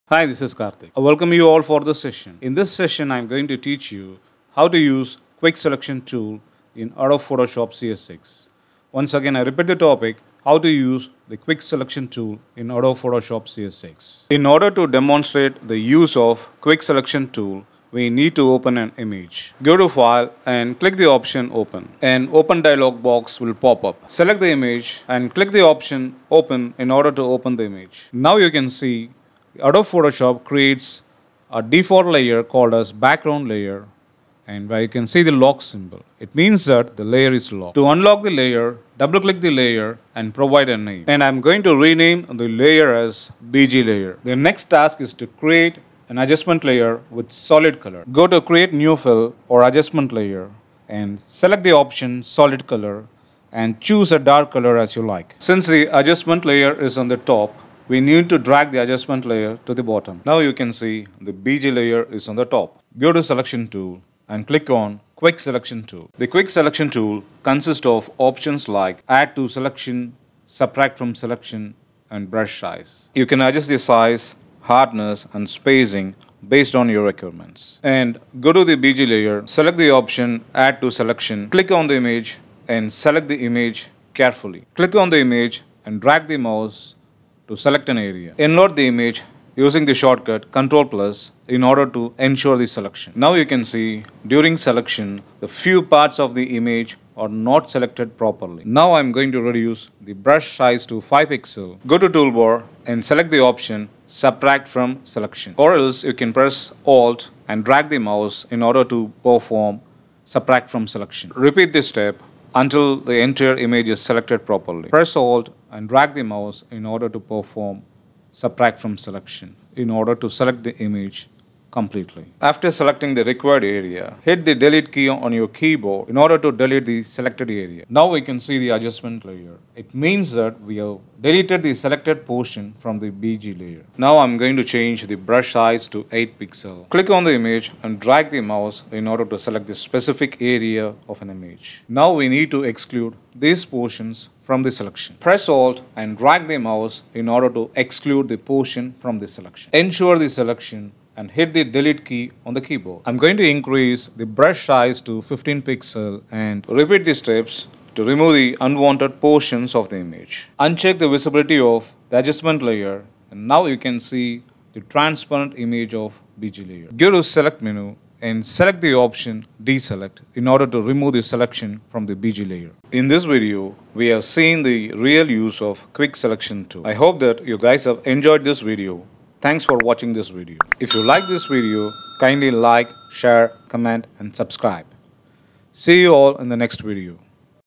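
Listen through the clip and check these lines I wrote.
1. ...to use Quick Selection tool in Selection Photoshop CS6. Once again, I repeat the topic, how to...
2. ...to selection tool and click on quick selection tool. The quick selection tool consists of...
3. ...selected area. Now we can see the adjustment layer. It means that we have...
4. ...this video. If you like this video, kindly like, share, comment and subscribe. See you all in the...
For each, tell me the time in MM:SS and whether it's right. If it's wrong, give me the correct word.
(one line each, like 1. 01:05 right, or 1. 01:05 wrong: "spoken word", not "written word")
1. 00:04 wrong: "Adobe", not "Selection"
2. 01:03 right
3. 02:07 right
4. 03:00 right.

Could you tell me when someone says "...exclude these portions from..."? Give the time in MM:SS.
02:22.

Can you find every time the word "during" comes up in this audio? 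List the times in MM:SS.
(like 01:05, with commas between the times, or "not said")
01:34.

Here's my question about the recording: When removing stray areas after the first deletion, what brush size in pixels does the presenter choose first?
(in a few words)
8 pixels.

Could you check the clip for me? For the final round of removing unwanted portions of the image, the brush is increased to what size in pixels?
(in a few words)
15 pixels.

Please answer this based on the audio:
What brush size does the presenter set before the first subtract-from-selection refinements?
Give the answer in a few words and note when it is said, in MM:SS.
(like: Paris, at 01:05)
5 pixels, at 01:41.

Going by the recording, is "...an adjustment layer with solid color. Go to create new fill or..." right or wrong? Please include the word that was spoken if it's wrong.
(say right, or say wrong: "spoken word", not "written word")
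right.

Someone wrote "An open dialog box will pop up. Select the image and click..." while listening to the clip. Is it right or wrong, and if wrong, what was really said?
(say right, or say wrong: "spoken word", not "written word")
right.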